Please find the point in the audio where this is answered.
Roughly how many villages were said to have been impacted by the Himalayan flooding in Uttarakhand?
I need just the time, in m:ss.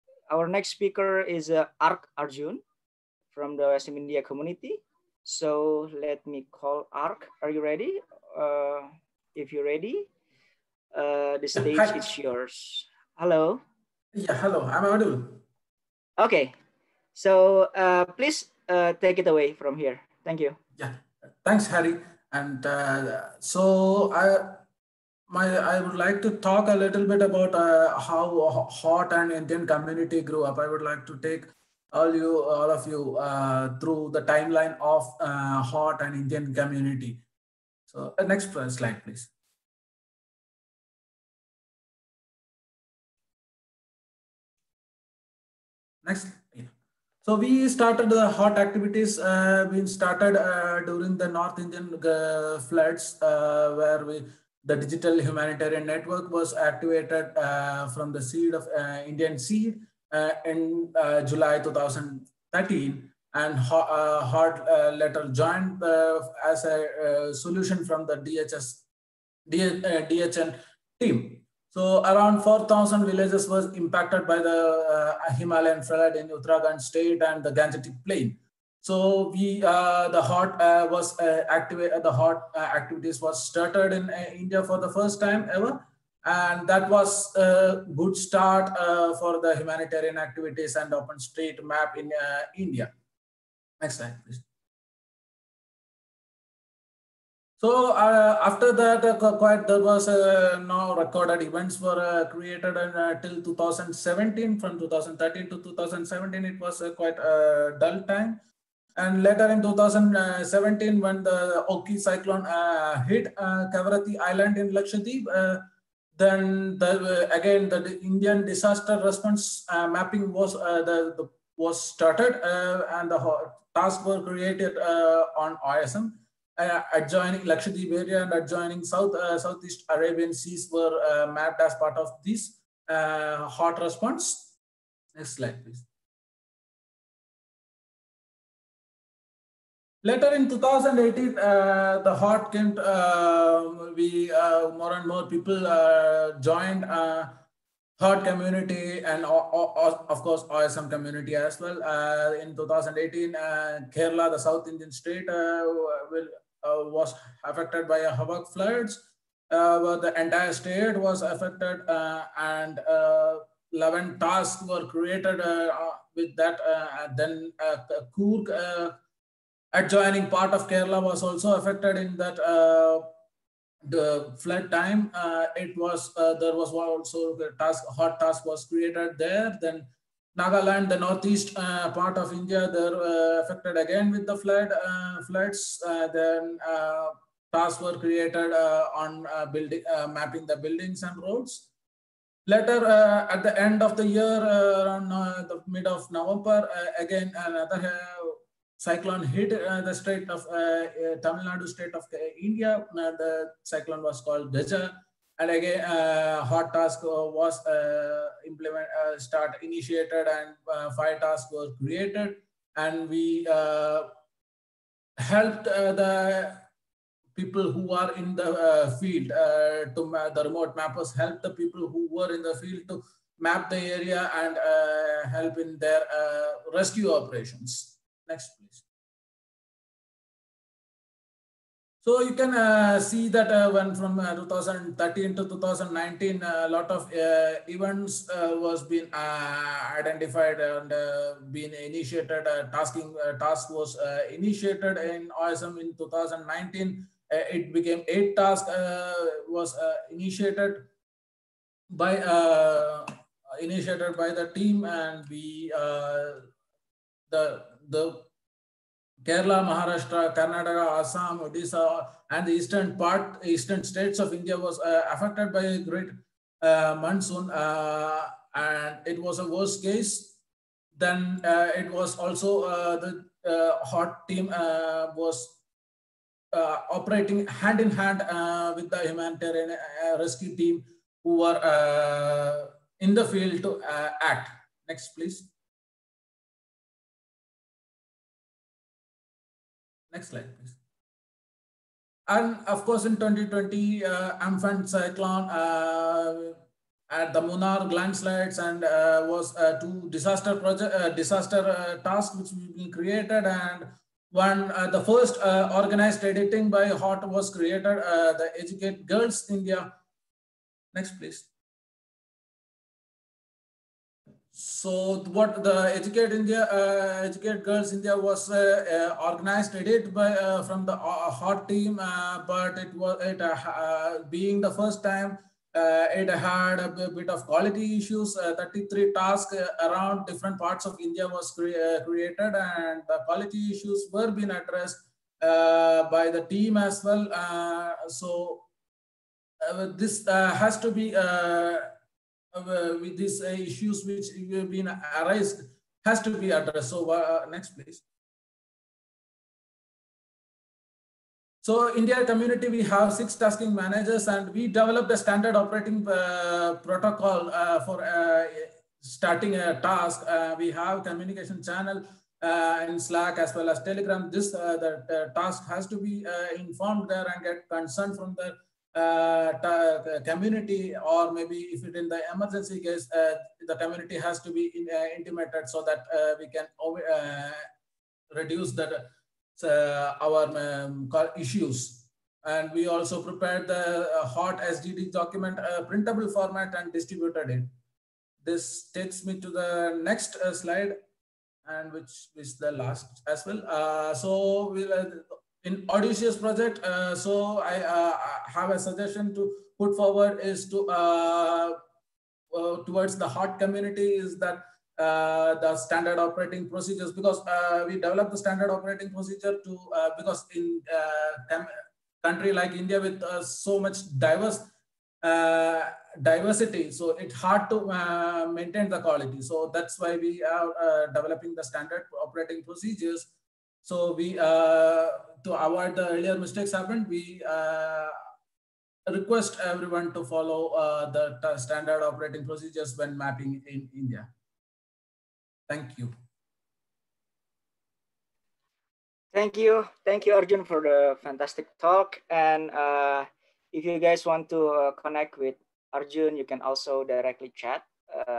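1:12.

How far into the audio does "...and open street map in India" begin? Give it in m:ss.
1:30.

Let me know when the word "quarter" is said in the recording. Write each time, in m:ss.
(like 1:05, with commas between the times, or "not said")
not said.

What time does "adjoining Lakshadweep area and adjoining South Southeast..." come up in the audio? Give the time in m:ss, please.
2:06.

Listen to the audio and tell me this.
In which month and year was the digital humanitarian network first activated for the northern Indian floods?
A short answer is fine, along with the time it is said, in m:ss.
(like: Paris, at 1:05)
July 2013, at 1:01.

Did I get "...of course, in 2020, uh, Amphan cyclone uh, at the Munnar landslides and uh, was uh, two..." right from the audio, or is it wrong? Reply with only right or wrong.
right.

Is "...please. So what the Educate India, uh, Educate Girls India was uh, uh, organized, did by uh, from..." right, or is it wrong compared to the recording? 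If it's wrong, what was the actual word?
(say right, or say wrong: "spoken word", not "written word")
right.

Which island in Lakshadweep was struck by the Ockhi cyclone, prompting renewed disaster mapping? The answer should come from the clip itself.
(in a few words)
Kavaratti Island.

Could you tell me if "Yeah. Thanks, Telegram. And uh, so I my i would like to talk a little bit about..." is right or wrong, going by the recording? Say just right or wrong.
wrong.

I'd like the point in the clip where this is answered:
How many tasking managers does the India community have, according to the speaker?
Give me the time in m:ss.
5:53.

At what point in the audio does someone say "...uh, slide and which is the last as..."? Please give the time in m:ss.
6:30.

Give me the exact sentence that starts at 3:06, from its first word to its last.
then tasks were created on building mapping the buildings and roads.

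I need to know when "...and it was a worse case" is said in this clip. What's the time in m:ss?
4:28.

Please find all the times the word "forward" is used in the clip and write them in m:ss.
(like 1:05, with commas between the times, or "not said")
6:39.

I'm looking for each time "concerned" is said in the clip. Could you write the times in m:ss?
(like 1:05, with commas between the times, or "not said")
6:07.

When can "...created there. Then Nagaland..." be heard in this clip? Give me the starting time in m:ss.
2:58.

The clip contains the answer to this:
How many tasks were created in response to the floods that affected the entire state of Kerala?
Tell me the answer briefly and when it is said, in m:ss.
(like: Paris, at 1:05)
11, at 2:43.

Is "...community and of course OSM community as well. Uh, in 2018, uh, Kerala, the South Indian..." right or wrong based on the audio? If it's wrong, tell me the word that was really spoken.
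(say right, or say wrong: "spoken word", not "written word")
right.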